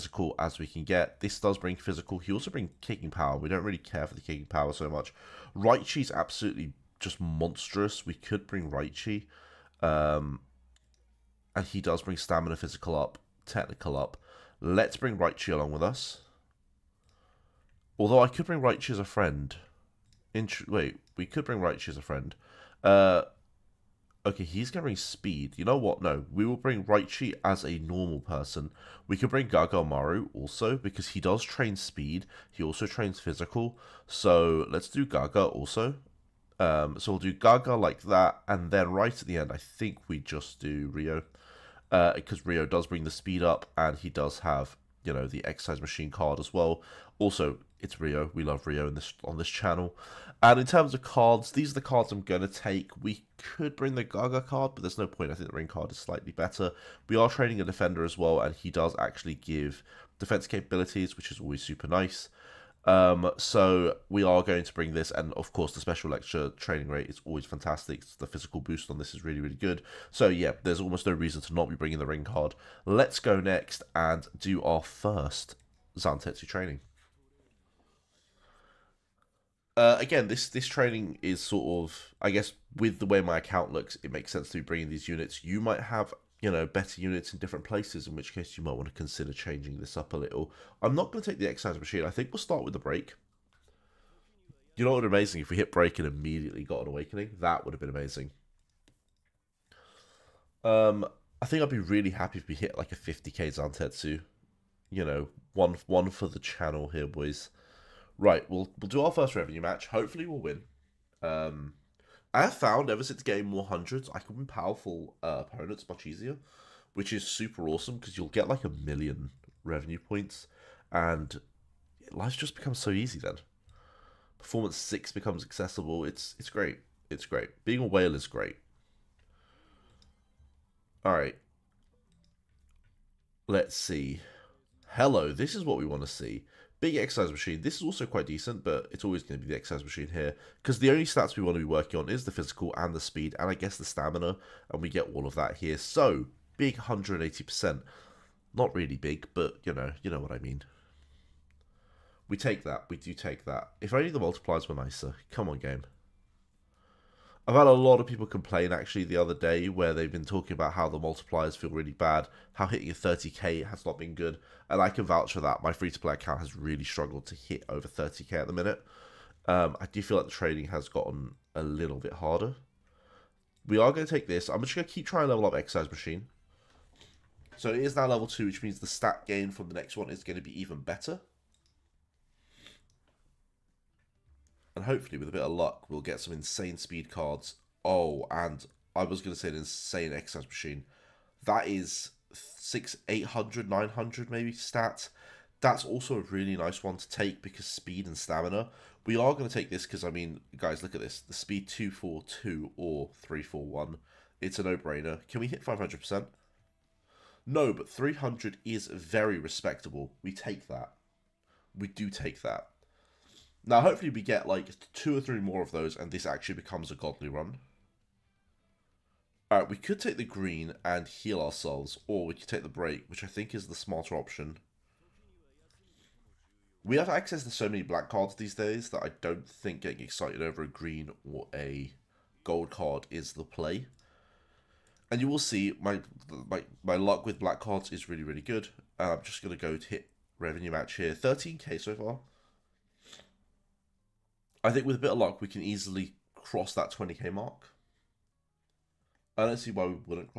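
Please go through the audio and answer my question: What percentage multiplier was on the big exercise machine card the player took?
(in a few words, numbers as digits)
180%.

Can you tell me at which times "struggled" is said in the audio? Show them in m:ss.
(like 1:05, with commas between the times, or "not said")
2:46.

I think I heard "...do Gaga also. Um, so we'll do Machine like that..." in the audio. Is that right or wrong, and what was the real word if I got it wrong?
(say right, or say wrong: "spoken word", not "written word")
wrong: "Gaga", not "Machine".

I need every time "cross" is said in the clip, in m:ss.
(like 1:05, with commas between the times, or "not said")
4:06.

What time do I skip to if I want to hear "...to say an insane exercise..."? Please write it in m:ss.
3:09.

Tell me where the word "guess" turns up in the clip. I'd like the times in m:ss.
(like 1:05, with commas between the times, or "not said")
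1:22, 2:23.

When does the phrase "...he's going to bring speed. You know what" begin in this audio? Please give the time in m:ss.
0:24.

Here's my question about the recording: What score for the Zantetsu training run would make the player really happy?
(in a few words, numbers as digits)
50k.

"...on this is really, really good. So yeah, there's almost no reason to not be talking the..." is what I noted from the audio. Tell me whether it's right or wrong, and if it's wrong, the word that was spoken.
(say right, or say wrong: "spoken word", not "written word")
wrong: "bringing", not "talking".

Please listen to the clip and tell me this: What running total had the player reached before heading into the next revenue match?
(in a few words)
13k.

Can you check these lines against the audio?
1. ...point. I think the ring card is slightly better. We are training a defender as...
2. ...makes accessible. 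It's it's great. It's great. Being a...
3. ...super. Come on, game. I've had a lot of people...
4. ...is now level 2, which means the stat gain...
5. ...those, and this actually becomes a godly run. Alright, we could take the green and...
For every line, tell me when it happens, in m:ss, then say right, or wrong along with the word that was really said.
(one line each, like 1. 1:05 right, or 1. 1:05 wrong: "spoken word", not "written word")
1. 0:55 right
2. 2:05 wrong: "becomes", not "makes"
3. 2:34 wrong: "nicer", not "super"
4. 2:57 right
5. 3:35 right.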